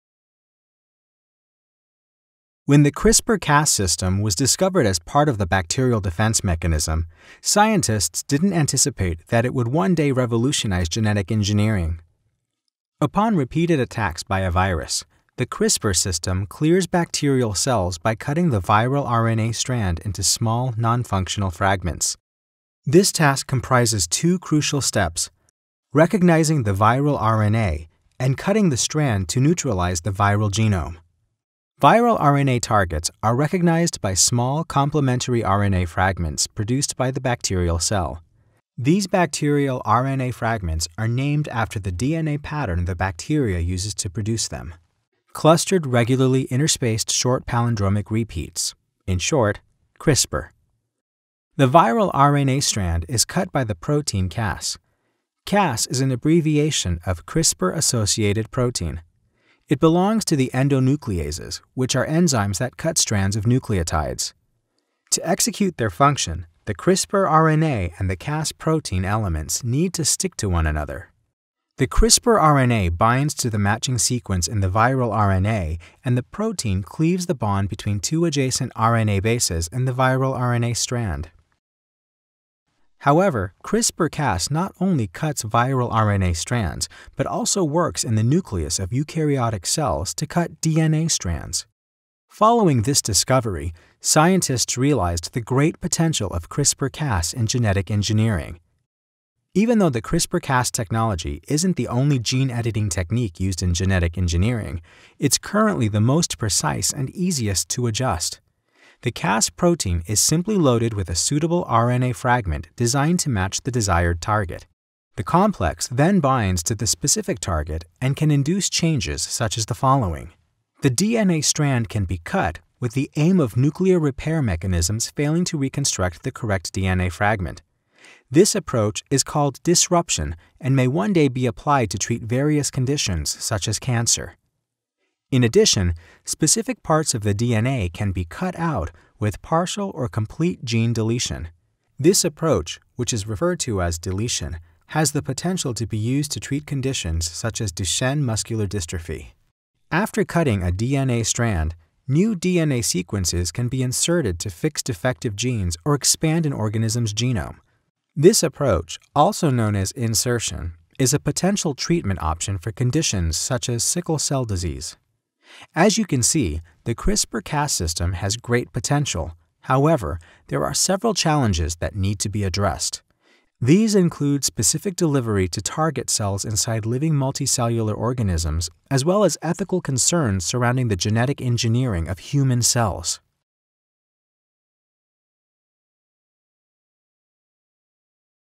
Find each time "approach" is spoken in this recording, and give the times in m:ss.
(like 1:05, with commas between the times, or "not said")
2:08, 2:22, 2:38.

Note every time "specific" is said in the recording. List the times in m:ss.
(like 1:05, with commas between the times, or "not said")
1:56, 2:16, 2:54.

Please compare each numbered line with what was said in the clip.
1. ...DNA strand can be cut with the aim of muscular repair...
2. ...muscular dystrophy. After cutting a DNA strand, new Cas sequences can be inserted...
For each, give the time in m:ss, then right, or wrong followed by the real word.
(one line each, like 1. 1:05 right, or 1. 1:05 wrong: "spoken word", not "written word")
1. 2:00 wrong: "nuclear", not "muscular"
2. 2:28 wrong: "DNA", not "Cas".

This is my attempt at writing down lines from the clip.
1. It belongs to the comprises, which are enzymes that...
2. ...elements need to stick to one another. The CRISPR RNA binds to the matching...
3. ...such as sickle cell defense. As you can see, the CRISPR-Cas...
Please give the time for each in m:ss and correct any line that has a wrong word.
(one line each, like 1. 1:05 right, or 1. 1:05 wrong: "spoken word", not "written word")
1. 0:59 wrong: "endonucleases", not "comprises"
2. 1:09 right
3. 2:43 wrong: "disease", not "defense".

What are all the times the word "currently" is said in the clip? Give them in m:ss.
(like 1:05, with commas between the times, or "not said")
1:45.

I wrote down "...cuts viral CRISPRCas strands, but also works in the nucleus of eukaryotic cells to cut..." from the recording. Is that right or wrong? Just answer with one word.
wrong.